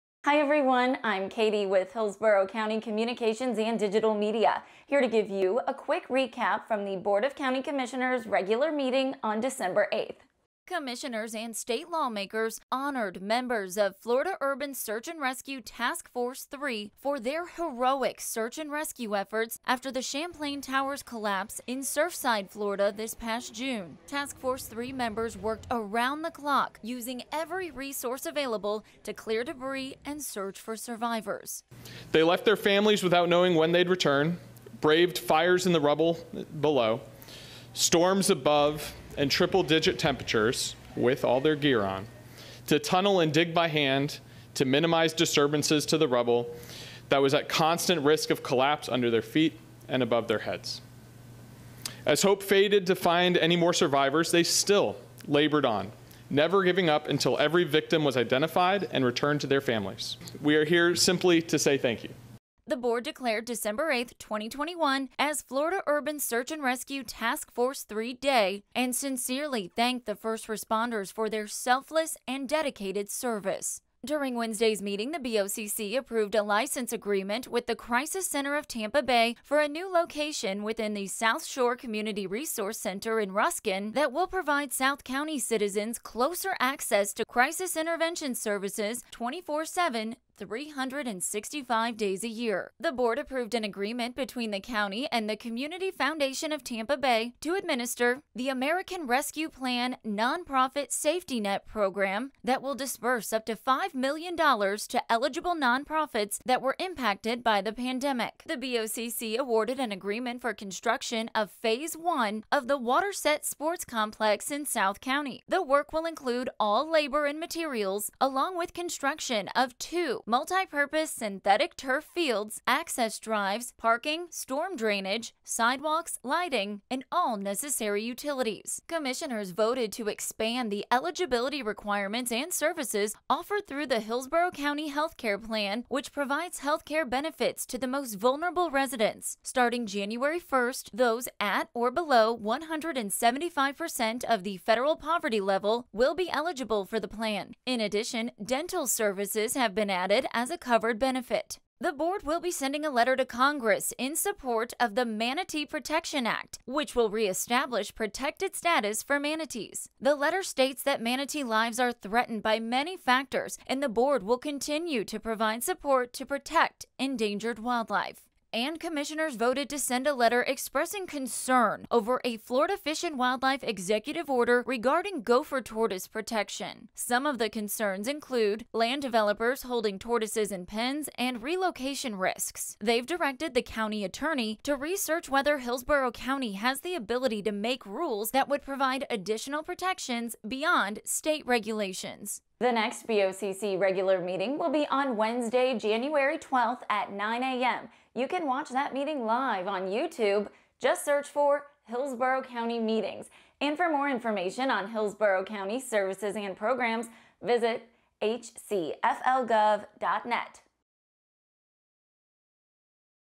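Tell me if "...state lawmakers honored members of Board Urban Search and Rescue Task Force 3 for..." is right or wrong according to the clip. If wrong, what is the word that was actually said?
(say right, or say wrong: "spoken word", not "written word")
wrong: "Florida", not "Board".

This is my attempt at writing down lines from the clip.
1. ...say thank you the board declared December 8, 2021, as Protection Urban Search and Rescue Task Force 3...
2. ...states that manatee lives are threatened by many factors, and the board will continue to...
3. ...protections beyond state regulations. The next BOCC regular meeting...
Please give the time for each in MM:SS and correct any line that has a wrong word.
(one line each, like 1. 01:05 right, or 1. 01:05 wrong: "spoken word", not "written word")
1. 01:01 wrong: "Florida", not "Protection"
2. 02:40 right
3. 03:09 right.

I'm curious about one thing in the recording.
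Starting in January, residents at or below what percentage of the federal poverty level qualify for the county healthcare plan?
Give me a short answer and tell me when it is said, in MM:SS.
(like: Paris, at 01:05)
175%, at 02:22.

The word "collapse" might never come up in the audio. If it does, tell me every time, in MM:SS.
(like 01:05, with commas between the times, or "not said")
00:21, 00:48.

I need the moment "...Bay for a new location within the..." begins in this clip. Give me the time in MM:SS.
01:19.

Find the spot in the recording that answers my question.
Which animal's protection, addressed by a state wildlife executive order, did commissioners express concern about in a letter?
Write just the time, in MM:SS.
02:55.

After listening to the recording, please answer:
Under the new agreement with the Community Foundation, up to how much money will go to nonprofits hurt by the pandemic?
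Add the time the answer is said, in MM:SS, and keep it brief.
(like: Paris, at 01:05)
$5 million, at 01:43.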